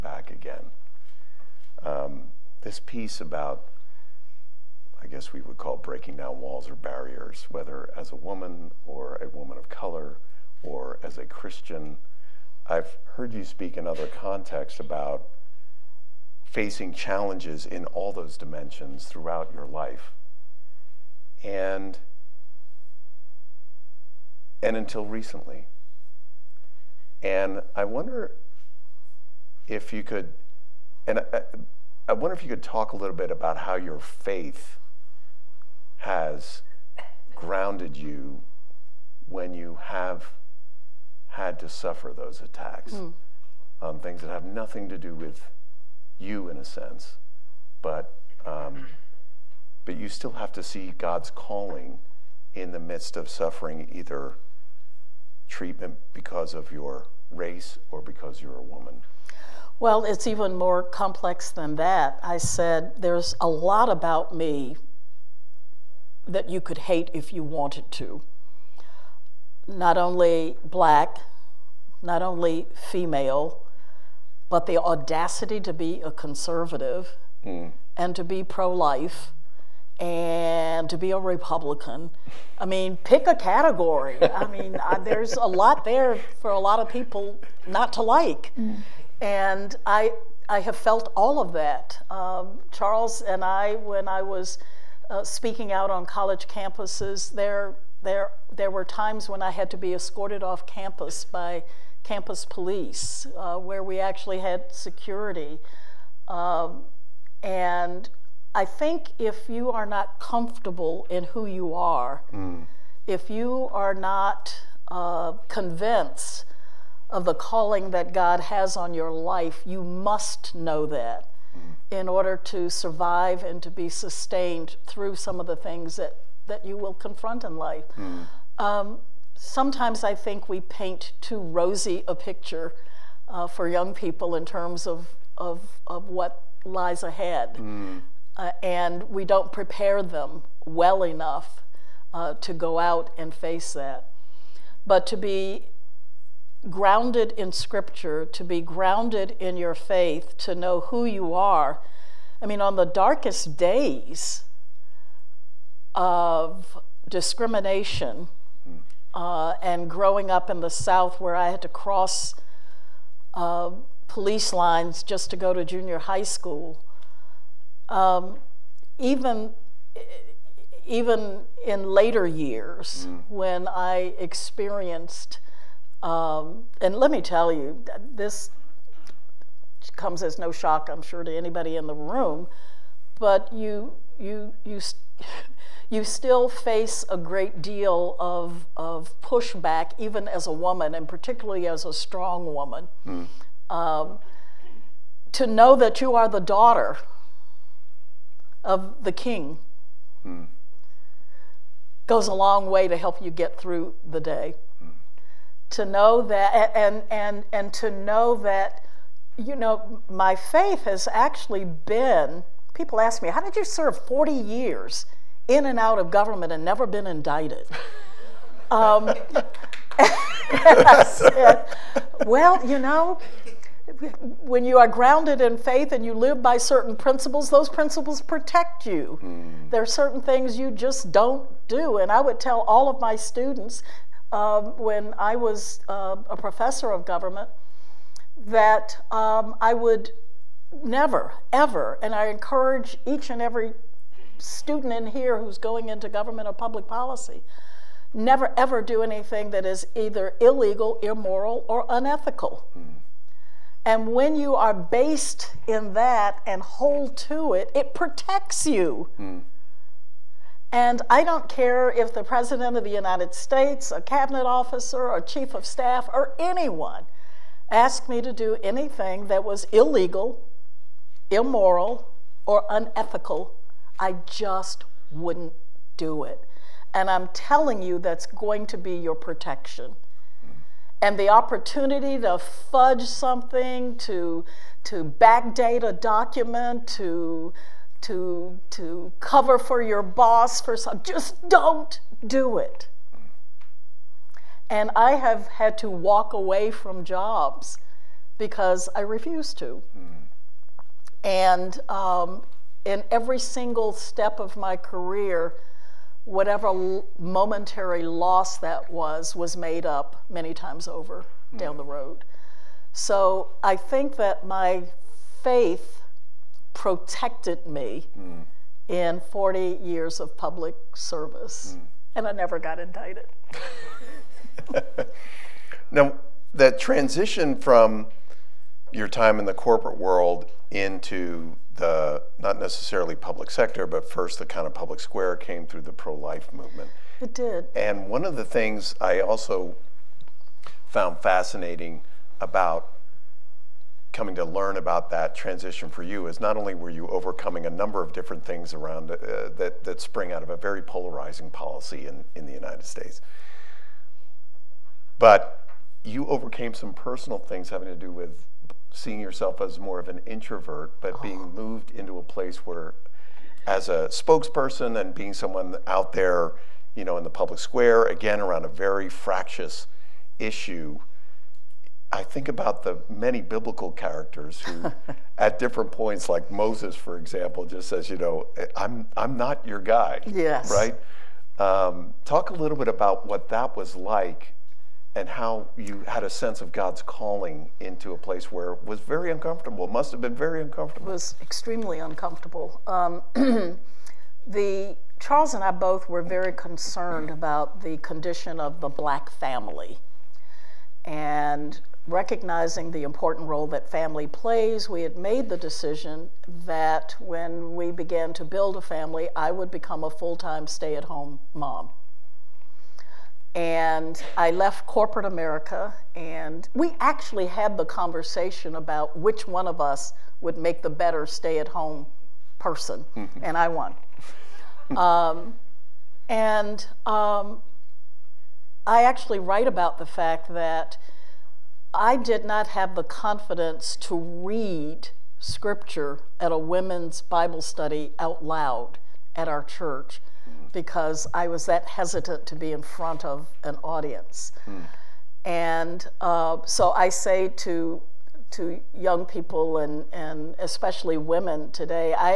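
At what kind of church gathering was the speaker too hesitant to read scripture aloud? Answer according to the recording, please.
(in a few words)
women's Bible study.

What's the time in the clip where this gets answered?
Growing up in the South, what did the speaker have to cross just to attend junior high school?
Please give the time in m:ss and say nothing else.
2:44.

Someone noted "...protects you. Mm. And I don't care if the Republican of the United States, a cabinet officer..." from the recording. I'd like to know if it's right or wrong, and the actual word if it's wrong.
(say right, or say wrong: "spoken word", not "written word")
wrong: "President", not "Republican".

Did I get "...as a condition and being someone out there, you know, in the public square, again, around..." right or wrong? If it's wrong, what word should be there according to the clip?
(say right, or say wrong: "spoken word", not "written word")
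wrong: "spokesperson", not "condition".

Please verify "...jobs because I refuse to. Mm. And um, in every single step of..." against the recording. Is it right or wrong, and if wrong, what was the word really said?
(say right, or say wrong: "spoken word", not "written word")
right.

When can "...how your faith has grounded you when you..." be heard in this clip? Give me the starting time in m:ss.
0:33.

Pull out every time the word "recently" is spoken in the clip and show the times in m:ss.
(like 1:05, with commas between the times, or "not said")
0:25.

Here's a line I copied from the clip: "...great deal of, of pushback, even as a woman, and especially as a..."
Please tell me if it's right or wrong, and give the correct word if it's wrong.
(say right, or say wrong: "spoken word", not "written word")
wrong: "particularly", not "especially".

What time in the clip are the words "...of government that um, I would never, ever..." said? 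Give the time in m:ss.
3:56.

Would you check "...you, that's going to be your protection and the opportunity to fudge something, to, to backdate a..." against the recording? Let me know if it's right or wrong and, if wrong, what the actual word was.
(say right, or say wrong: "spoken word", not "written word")
right.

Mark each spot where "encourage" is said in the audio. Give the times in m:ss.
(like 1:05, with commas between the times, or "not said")
4:02.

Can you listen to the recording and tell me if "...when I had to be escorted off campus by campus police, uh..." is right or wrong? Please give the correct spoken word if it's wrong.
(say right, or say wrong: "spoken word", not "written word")
right.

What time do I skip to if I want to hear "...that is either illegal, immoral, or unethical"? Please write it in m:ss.
4:09.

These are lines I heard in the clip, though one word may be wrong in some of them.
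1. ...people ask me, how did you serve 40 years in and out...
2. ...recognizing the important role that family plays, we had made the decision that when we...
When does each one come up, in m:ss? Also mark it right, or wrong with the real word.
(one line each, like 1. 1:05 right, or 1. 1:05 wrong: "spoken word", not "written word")
1. 3:32 right
2. 6:42 right.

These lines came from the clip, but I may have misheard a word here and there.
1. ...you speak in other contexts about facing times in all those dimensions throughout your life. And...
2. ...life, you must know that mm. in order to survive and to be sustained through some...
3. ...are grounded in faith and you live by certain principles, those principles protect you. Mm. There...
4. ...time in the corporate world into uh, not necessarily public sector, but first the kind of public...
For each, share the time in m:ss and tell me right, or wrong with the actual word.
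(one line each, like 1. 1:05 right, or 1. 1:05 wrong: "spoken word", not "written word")
1. 0:13 wrong: "challenges", not "times"
2. 1:59 right
3. 3:44 right
4. 5:29 right.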